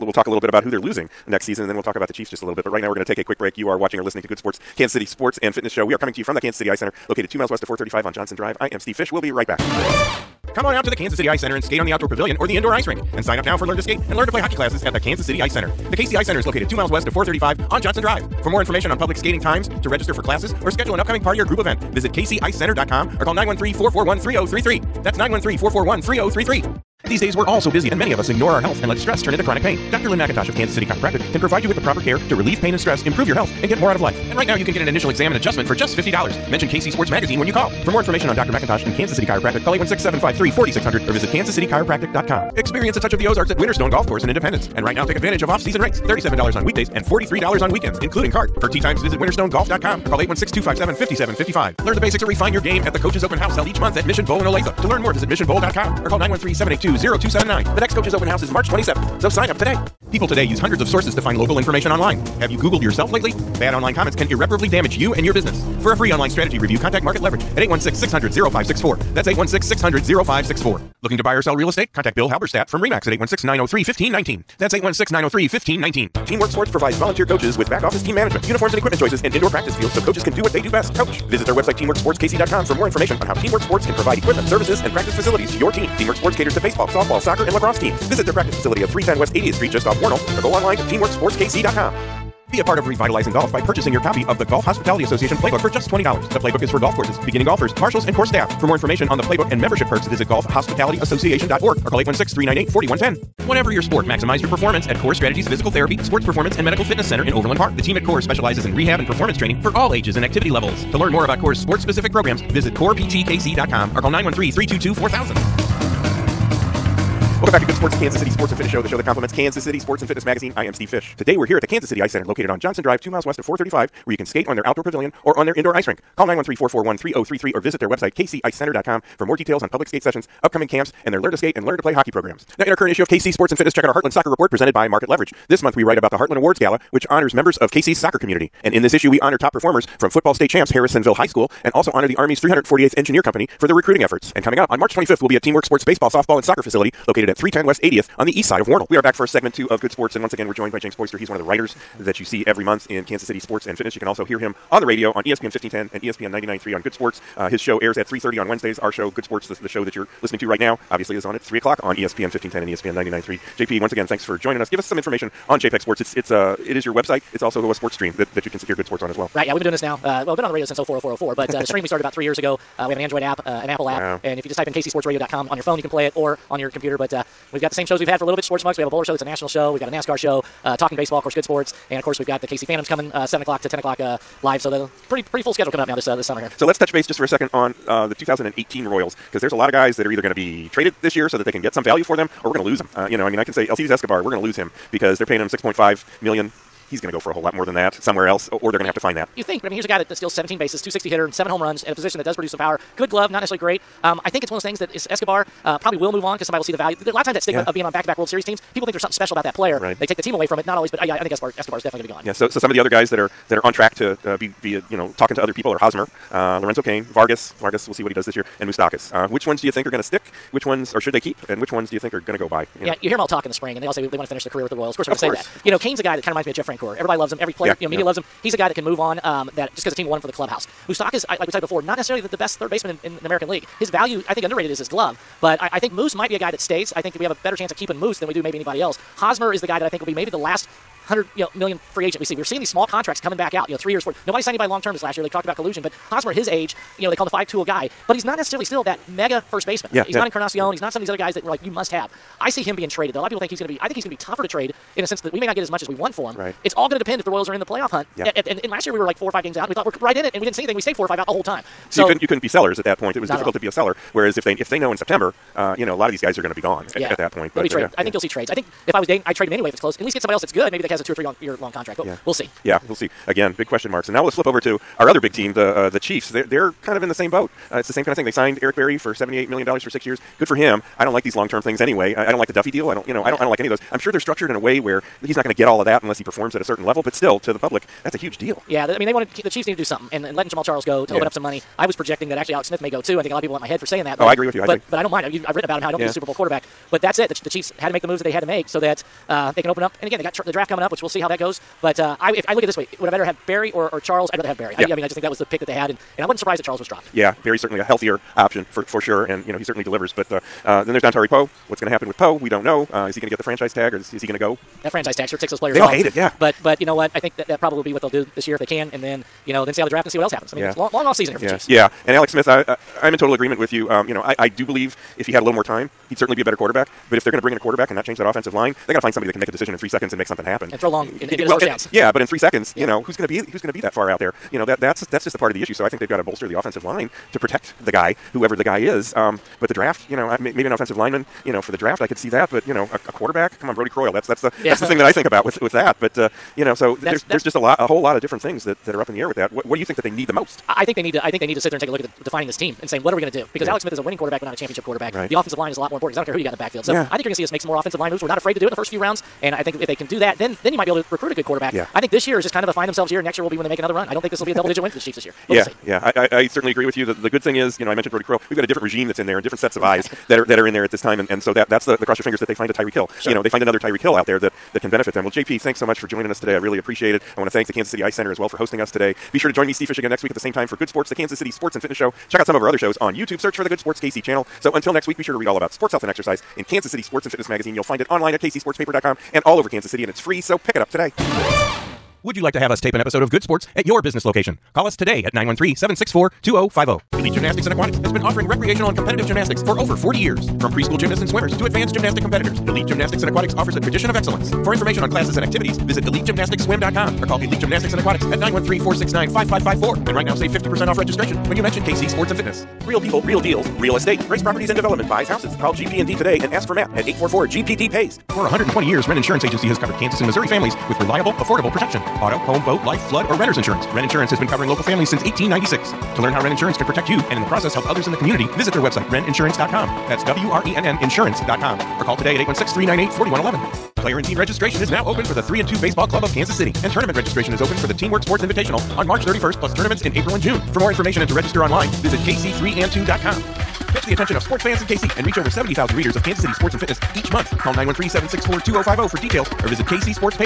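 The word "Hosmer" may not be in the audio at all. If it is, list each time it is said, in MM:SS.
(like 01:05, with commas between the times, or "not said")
03:35, 03:59, 04:06.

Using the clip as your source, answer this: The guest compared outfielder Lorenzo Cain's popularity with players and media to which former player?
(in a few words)
Jeff Francoeur.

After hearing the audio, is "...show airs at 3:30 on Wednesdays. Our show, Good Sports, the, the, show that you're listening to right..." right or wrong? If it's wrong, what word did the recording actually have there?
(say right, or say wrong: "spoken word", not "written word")
right.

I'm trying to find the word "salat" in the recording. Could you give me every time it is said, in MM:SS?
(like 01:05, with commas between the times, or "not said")
not said.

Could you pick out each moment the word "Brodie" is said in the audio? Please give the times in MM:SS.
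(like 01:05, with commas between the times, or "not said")
05:43, 06:08.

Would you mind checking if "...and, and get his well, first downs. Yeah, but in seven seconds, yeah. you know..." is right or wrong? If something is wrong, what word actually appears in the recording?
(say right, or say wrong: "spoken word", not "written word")
wrong: "three", not "seven".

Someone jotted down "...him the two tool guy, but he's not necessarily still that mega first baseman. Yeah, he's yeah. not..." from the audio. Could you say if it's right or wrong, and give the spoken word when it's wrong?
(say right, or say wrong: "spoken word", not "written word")
wrong: "five", not "two".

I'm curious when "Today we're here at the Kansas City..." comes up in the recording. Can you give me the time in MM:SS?
02:01.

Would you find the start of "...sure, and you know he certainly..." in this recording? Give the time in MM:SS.
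05:08.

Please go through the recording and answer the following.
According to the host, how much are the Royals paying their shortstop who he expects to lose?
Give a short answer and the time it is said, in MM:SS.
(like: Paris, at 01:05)
6.5 million, at 03:15.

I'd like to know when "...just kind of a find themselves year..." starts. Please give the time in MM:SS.
06:02.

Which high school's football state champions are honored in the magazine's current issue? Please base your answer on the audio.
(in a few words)
Harrisonville High School.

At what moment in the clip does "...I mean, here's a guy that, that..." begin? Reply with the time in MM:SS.
03:19.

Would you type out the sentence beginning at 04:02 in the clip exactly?
We're seeing these small contracts coming back out.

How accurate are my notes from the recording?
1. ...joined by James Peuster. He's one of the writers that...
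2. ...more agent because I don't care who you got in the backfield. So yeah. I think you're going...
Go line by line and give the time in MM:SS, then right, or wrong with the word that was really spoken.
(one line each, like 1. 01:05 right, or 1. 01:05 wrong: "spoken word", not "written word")
1. 02:30 right
2. 05:55 wrong: "important", not "agent".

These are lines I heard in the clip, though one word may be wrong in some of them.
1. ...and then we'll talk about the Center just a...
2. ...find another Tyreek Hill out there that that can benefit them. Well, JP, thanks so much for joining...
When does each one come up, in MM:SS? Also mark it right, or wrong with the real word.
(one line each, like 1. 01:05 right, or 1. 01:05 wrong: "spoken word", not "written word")
1. 00:01 wrong: "Chiefs", not "Center"
2. 06:13 right.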